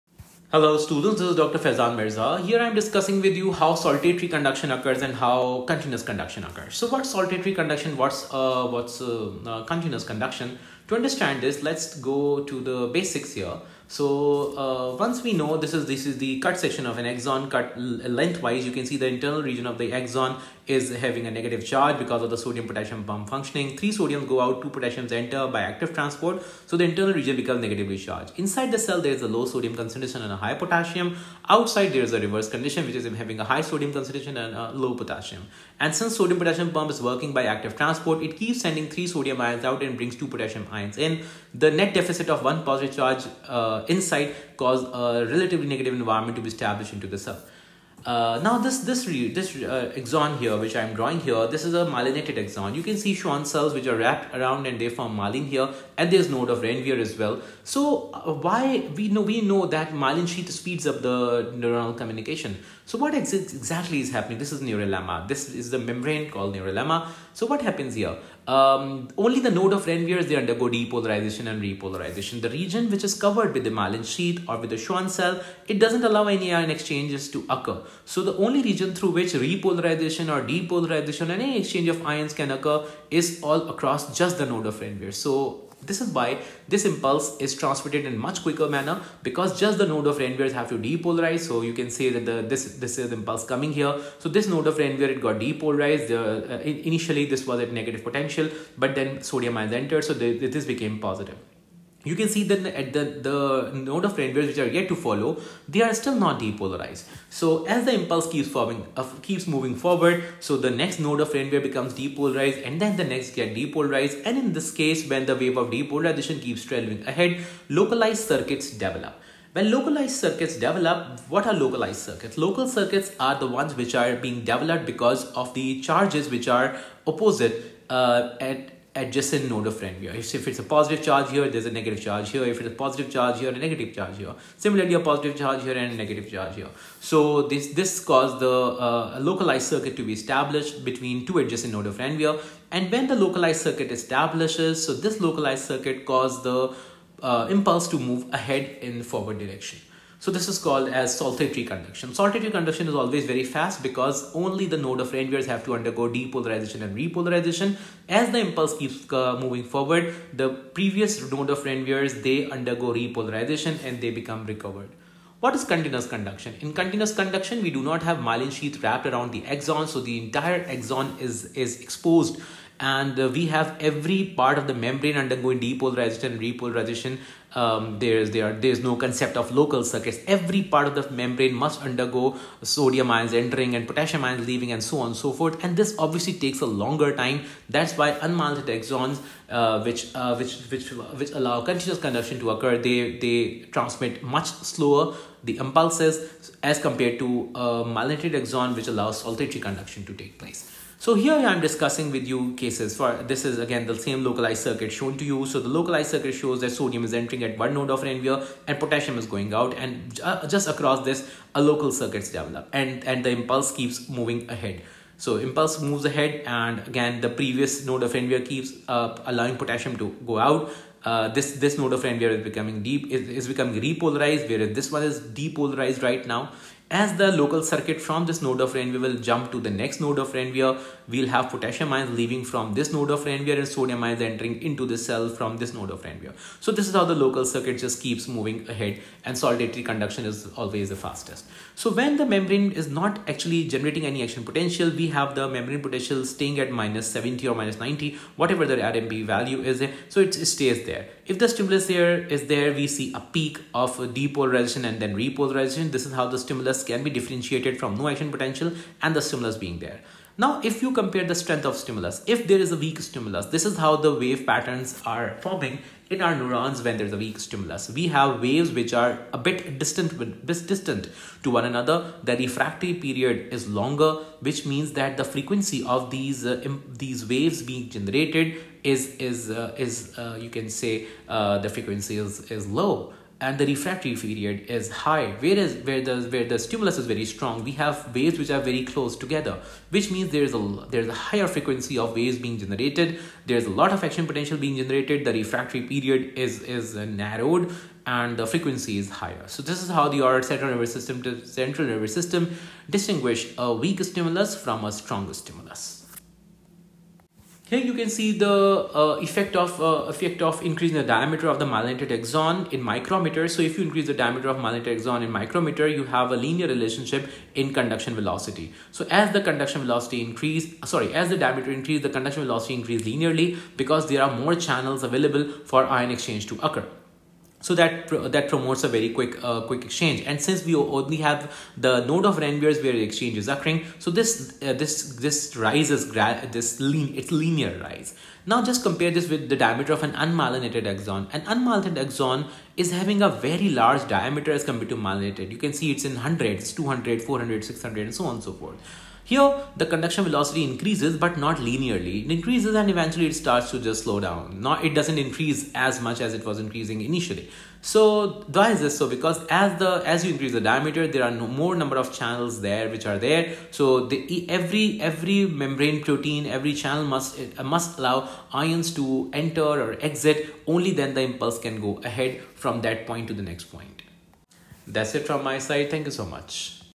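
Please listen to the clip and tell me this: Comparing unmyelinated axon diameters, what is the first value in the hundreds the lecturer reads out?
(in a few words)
200.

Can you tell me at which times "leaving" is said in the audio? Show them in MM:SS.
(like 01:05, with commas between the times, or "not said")
03:04, 03:52.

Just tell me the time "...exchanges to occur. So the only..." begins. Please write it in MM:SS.
01:16.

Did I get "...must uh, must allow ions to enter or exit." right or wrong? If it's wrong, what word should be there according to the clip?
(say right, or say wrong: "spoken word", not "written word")
right.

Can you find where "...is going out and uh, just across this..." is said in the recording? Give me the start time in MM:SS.
03:29.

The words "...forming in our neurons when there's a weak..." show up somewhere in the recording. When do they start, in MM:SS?
04:25.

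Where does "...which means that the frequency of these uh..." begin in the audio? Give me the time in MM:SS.
04:34.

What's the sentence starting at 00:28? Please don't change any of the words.
Inside the cell, there is a low sodium concentration and a high potassium.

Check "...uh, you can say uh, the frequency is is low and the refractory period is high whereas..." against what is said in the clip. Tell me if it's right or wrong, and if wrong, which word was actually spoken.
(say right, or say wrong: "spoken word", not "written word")
right.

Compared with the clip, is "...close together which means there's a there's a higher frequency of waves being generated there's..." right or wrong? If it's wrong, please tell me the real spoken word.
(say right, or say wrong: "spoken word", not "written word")
right.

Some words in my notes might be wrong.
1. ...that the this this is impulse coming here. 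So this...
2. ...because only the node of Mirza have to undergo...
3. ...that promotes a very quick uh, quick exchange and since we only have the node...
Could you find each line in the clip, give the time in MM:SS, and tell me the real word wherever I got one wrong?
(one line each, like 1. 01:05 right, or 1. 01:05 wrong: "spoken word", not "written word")
1. 01:32 right
2. 02:33 wrong: "Ranvier", not "Mirza"
3. 05:28 right.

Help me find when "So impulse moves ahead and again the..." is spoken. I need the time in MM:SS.
03:35.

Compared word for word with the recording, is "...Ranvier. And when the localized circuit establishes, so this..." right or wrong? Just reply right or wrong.
right.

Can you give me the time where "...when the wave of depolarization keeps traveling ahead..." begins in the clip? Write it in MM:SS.
01:55.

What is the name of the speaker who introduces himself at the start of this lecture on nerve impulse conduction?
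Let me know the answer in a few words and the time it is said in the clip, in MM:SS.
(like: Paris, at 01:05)
Faizan Mirza, at 00:01.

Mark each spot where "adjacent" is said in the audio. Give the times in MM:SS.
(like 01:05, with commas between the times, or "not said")
02:08, 02:21.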